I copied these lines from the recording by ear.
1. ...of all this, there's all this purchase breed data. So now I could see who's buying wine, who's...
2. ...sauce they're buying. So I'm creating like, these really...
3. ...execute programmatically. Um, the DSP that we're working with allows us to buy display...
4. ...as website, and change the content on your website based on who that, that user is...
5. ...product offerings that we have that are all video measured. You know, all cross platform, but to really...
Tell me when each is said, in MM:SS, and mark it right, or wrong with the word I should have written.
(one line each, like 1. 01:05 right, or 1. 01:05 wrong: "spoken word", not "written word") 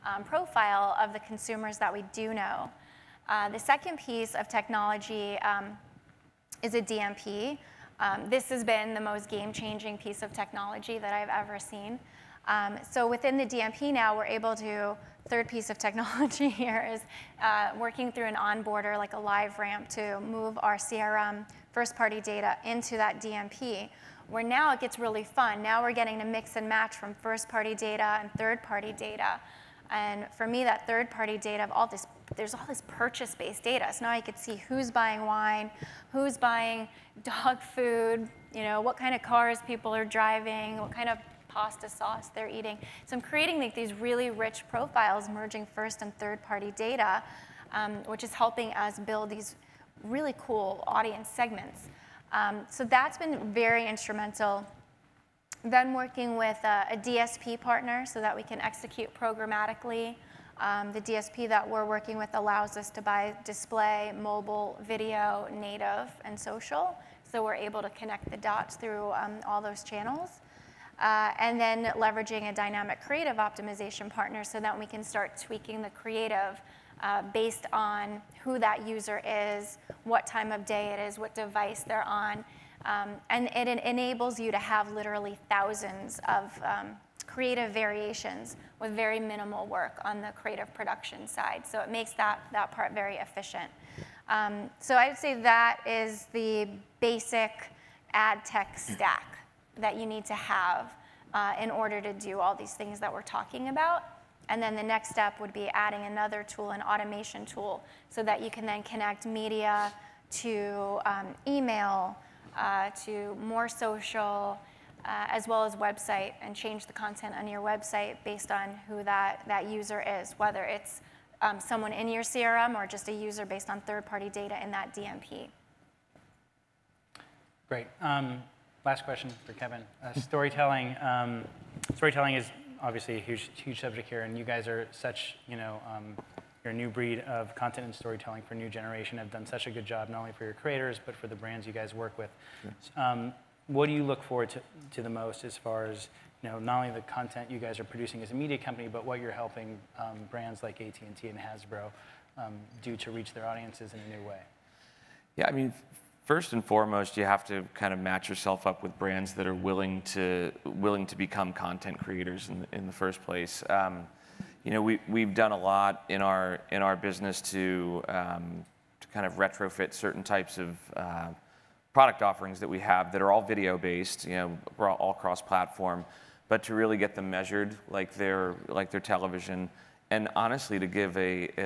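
1. 00:31 wrong: "based", not "breed"
2. 00:41 wrong: "eating", not "buying"
3. 00:58 right
4. 01:55 right
5. 02:51 wrong: "based", not "measured".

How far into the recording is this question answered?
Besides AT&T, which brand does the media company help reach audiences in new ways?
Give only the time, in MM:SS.
02:31.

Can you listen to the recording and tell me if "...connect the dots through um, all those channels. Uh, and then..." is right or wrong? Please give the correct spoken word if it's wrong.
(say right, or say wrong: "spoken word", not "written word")
right.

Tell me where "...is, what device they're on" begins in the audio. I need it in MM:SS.
01:20.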